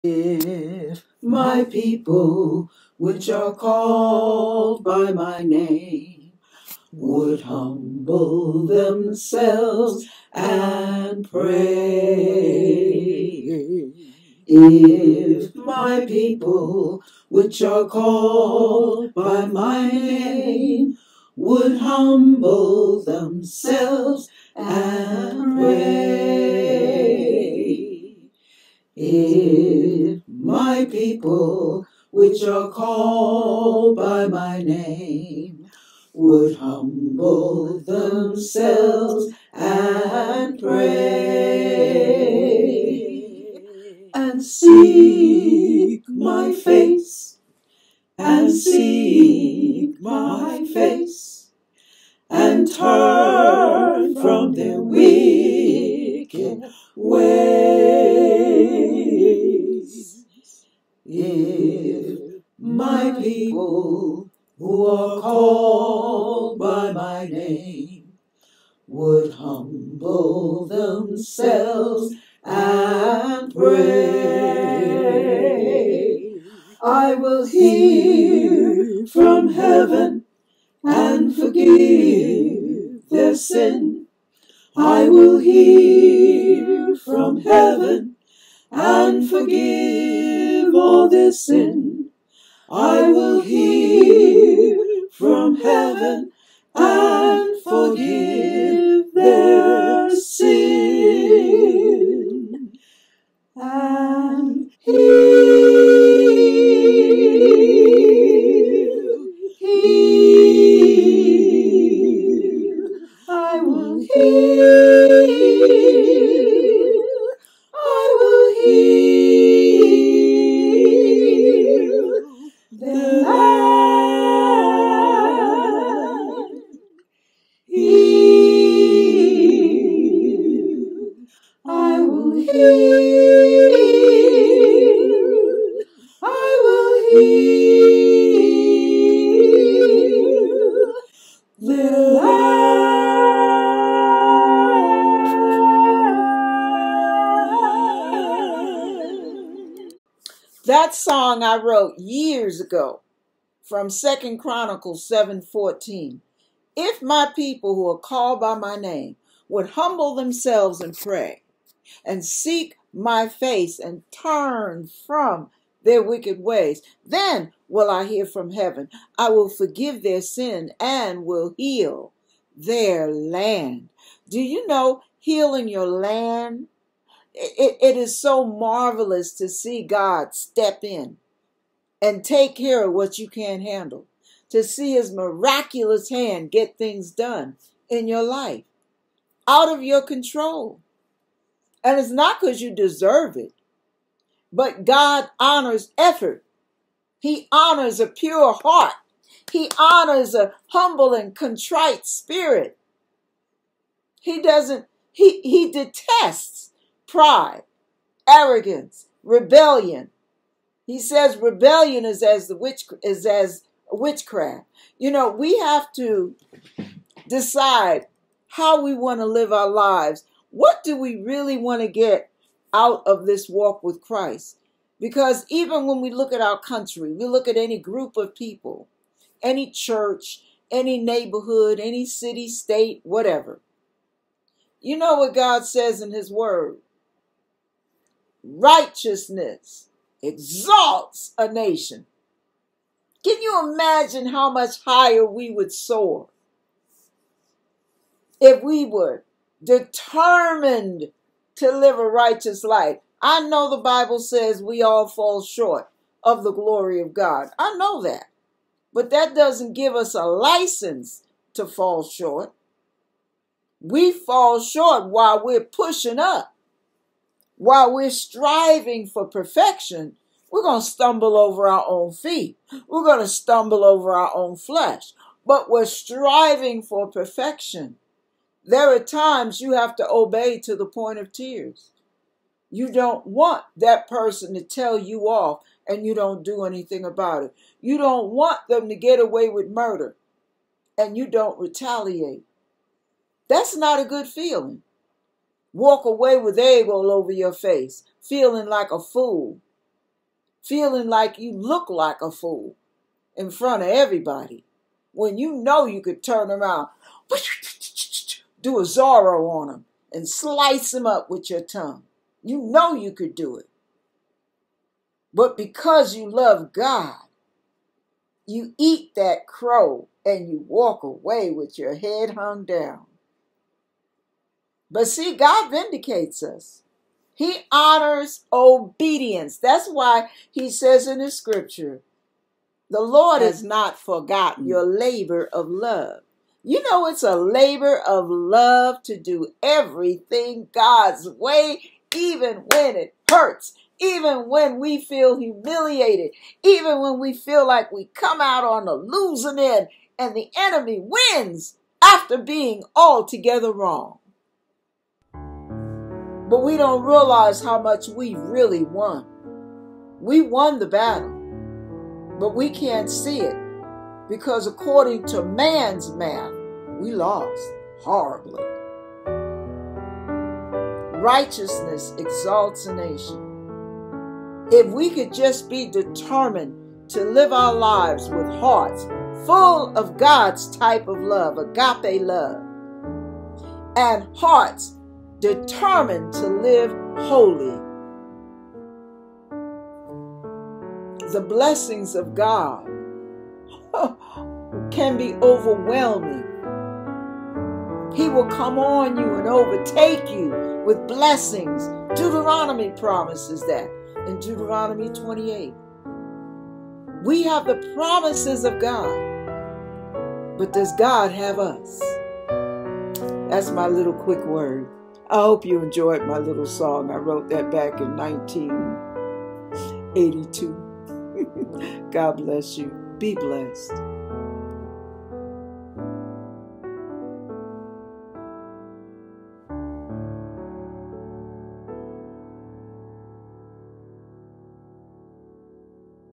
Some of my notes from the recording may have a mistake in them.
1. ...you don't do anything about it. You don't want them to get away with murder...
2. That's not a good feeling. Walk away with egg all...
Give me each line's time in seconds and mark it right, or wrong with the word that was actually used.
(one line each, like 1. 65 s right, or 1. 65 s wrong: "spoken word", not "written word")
1. 286 s right
2. 293 s right.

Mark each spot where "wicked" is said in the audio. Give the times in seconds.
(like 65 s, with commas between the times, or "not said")
54 s, 166 s.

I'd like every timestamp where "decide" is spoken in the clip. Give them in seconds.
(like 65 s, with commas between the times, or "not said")
217 s.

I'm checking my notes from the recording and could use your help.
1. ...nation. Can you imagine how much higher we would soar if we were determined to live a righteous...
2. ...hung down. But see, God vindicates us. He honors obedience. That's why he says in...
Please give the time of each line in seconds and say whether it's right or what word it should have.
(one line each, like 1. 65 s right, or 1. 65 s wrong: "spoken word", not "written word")
1. 241 s right
2. 322 s right.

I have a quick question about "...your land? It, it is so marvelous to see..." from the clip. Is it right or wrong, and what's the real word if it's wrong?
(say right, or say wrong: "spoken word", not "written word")
right.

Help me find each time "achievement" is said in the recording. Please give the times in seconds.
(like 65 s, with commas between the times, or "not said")
not said.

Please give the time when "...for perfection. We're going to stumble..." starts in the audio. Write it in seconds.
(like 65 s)
269 s.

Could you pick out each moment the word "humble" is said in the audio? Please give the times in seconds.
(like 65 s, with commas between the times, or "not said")
7 s, 21 s, 36 s, 69 s, 159 s, 200 s.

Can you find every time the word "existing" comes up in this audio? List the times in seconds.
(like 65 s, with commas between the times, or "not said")
not said.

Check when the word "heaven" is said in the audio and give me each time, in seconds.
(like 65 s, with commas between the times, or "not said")
79 s, 87 s, 95 s, 168 s.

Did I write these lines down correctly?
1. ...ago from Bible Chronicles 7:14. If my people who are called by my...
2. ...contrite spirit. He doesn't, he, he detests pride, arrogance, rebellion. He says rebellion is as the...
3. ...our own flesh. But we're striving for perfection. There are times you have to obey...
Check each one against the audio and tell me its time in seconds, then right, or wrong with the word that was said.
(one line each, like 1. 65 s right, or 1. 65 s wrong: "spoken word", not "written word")
1. 152 s wrong: "Second", not "Bible"
2. 201 s right
3. 274 s right.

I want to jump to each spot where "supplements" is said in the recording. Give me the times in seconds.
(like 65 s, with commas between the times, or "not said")
not said.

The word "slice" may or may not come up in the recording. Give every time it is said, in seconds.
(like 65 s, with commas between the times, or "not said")
310 s.